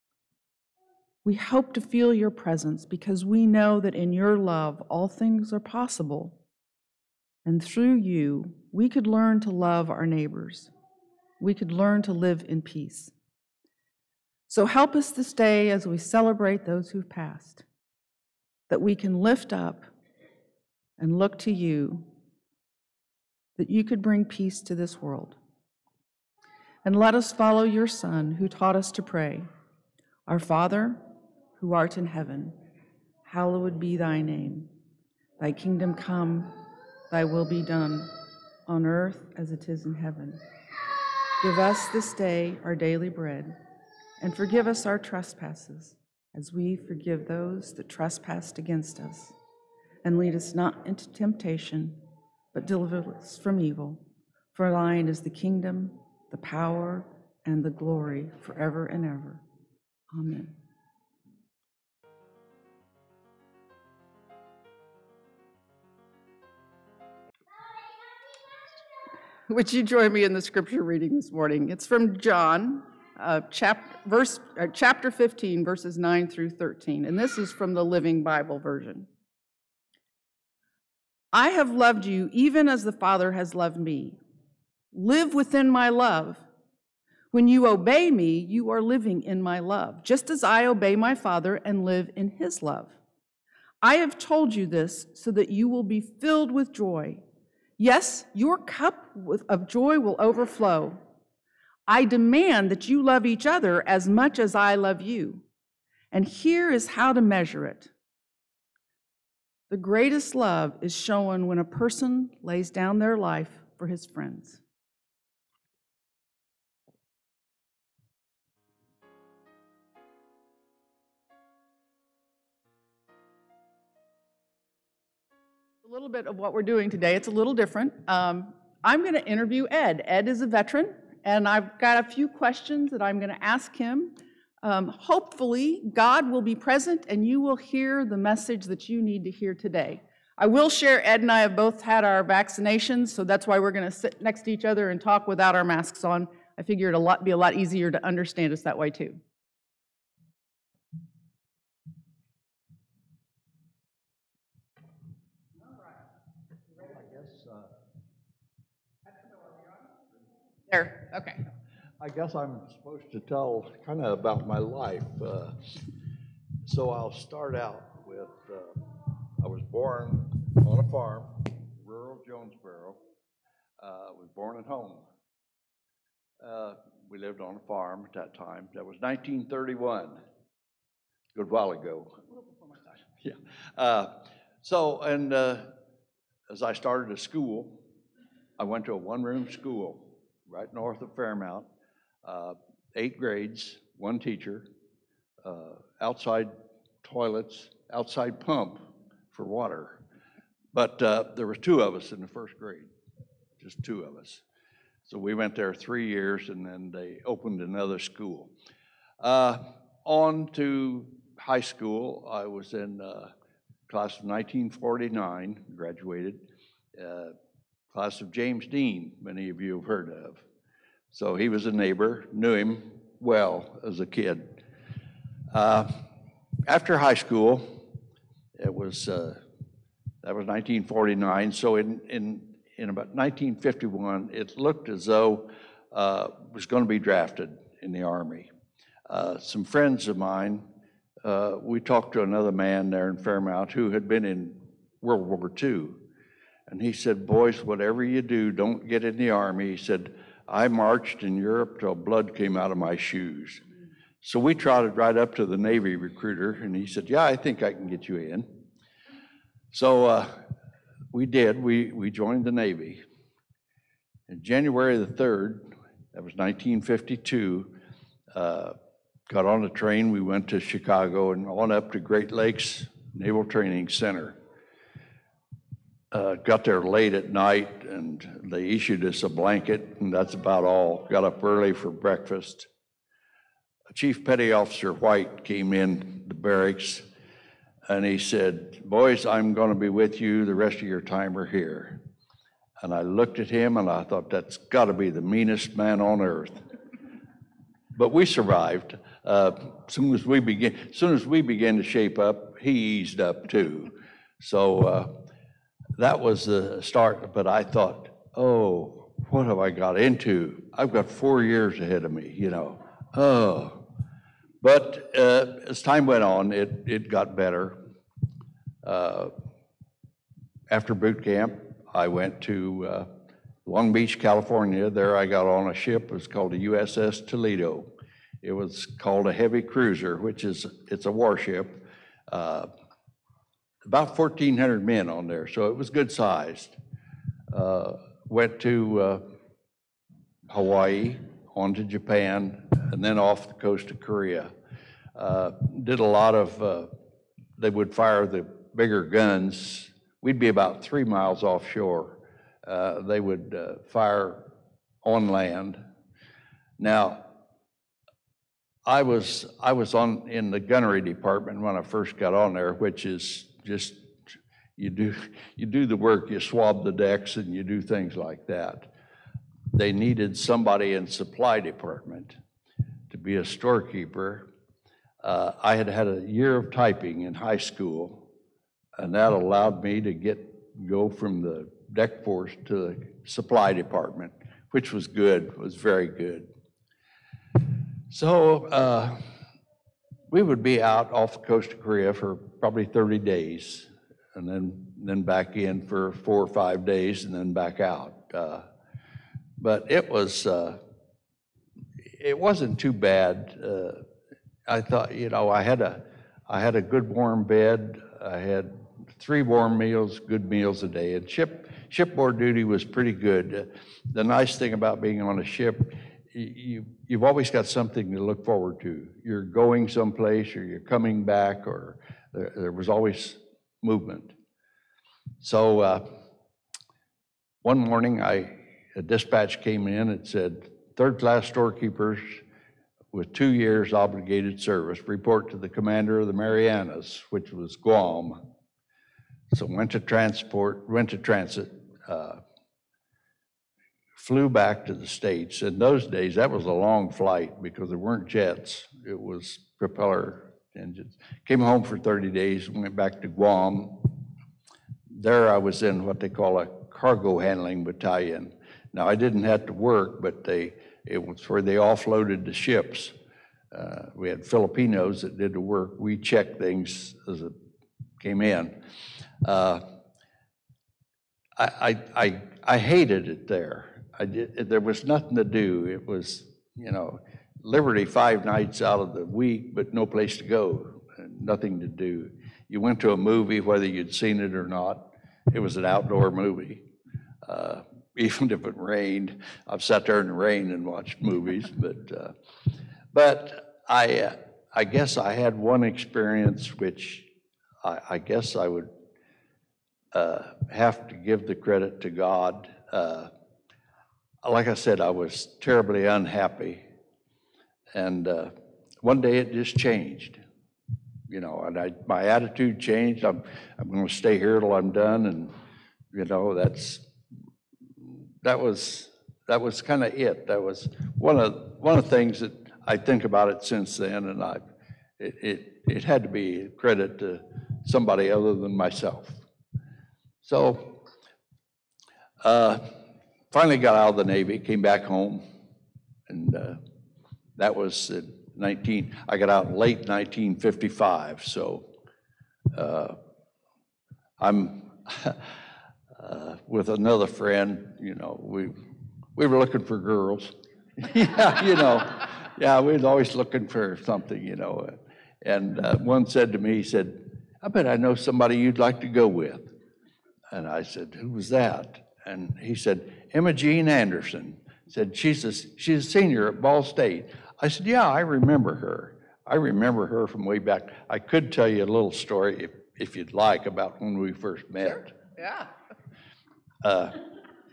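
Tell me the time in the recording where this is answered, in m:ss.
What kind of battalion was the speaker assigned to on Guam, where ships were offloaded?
7:36.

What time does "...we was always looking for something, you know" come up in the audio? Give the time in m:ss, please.
9:12.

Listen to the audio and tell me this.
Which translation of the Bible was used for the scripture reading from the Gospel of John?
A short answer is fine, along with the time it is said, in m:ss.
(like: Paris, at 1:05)
Living Bible, at 1:17.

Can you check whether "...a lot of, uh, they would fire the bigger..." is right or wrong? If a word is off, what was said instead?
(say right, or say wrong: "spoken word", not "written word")
right.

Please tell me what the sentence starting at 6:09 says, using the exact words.
They needed somebody in supply department to be a storekeeper.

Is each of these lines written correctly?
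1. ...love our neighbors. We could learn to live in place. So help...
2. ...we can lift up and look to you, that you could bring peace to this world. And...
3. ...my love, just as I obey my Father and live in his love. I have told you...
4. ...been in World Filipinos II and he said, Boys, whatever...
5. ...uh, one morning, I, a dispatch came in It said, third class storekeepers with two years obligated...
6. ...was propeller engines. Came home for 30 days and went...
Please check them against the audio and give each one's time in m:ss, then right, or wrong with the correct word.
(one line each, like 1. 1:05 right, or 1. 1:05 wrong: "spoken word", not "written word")
1. 0:09 wrong: "peace", not "place"
2. 0:18 right
3. 1:29 right
4. 4:04 wrong: "War", not "Filipinos"
5. 7:05 right
6. 7:29 right.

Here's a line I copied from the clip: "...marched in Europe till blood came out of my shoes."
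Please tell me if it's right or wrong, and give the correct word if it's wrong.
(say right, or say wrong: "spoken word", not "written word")
right.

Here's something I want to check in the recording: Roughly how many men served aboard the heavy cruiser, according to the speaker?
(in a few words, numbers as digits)
1,400.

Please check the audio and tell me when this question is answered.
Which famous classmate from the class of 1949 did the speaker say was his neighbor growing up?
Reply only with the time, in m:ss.
3:38.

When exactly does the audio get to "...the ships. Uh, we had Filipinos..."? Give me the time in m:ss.
7:42.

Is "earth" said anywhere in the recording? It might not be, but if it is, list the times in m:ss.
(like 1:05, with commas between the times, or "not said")
0:38, 4:56.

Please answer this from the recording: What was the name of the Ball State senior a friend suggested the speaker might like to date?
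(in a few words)
Emma Jean Anderson.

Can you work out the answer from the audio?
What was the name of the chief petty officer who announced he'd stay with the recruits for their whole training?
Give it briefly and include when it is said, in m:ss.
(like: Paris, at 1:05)
White, at 4:44.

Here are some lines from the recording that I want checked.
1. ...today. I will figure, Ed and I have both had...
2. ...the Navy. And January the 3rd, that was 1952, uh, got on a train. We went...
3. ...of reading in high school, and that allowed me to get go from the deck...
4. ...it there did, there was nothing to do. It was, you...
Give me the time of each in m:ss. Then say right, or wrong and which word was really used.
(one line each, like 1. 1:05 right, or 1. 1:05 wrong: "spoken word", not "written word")
1. 2:19 wrong: "share", not "figure"
2. 4:22 right
3. 6:16 wrong: "typing", not "reading"
4. 7:53 right.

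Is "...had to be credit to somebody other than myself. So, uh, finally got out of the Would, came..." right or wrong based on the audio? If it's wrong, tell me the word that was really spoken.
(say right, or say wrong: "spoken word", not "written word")
wrong: "Navy", not "Would".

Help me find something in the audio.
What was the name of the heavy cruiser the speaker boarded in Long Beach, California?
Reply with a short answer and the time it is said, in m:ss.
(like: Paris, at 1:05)
USS Toledo, at 5:26.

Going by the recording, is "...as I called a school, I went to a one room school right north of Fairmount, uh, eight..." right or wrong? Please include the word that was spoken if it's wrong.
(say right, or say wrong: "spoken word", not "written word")
wrong: "started", not "called".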